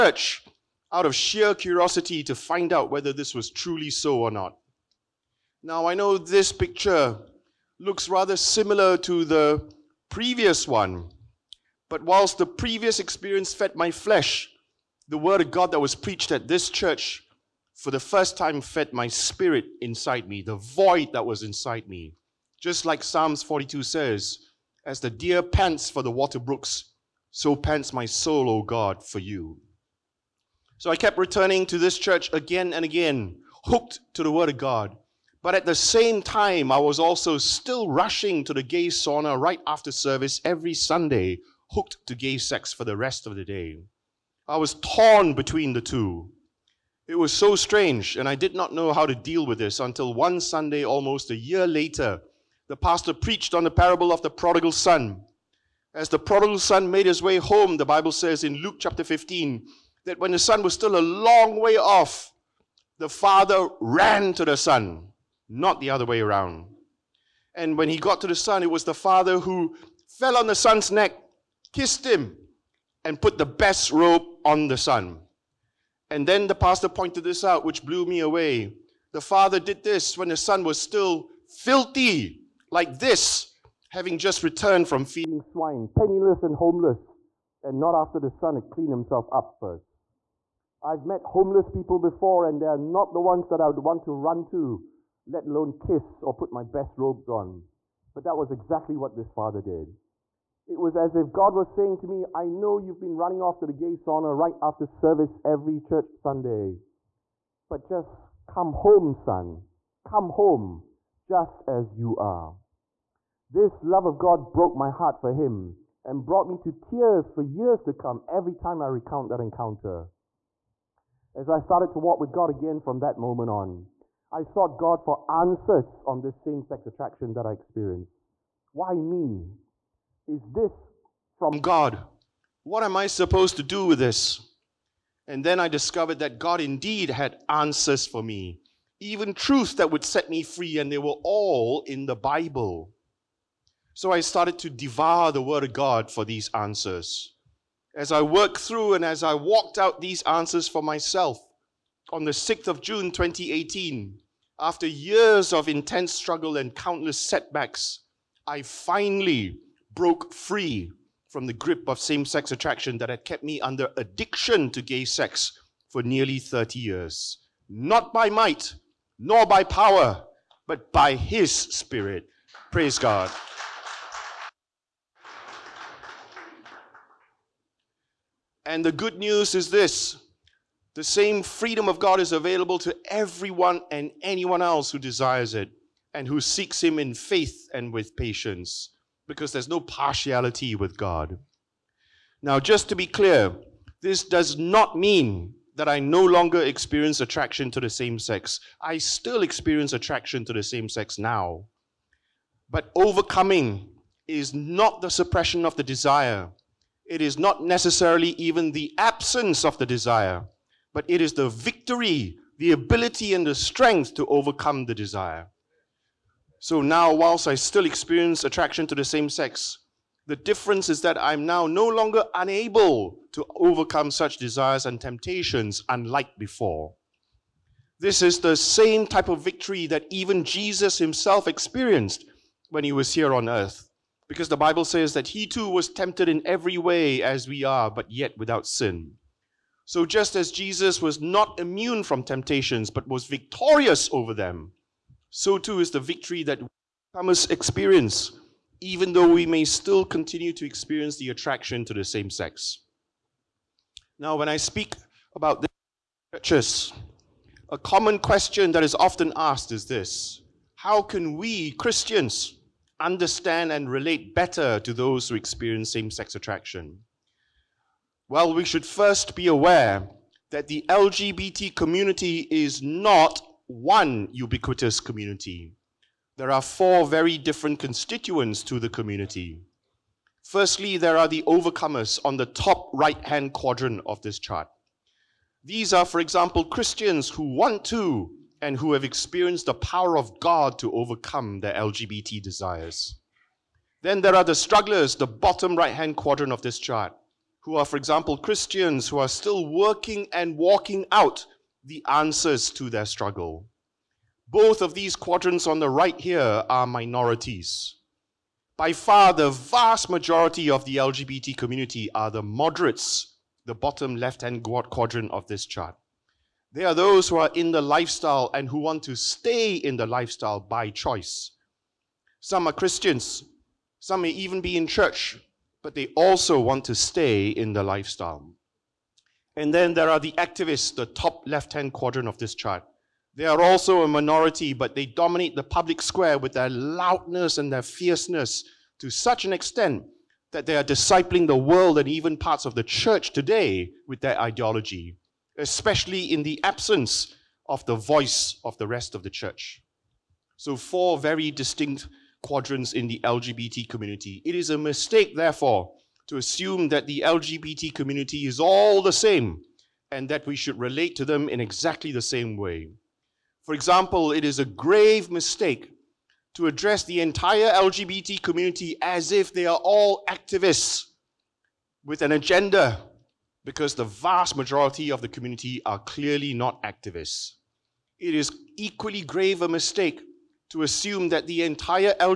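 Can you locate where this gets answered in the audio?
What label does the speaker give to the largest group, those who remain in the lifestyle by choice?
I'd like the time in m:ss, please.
5:12.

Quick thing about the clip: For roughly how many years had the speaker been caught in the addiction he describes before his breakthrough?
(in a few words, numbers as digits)
30 years.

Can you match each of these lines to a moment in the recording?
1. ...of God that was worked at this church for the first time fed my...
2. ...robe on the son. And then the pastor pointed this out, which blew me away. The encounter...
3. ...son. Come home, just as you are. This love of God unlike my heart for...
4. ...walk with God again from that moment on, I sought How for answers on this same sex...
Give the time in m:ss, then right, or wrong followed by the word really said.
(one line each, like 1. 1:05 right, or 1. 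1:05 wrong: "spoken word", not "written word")
1. 0:15 wrong: "preached", not "worked"
2. 1:13 wrong: "father", not "encounter"
3. 1:49 wrong: "broke", not "unlike"
4. 2:01 wrong: "God", not "How".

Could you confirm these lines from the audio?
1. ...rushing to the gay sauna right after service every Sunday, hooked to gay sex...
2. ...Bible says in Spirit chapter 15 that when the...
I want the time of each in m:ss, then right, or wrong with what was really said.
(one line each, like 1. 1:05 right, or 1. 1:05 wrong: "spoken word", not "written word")
1. 0:37 right
2. 0:57 wrong: "Luke", not "Spirit".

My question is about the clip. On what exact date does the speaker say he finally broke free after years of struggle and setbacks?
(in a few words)
6 June 2018.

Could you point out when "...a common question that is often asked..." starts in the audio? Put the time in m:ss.
4:17.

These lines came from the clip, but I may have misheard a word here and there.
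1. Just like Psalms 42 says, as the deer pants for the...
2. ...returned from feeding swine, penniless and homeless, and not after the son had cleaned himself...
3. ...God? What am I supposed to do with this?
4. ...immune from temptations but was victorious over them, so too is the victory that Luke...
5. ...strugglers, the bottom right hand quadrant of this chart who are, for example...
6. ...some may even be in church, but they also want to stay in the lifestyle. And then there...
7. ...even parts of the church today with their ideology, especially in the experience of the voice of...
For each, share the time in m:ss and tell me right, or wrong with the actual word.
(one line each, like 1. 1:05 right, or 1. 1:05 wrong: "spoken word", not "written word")
1. 0:22 right
2. 1:24 right
3. 2:11 right
4. 4:01 wrong: "Thomas", not "Luke"
5. 4:54 right
6. 5:23 right
7. 5:42 wrong: "absence", not "experience".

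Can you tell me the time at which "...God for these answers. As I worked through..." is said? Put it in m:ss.
2:25.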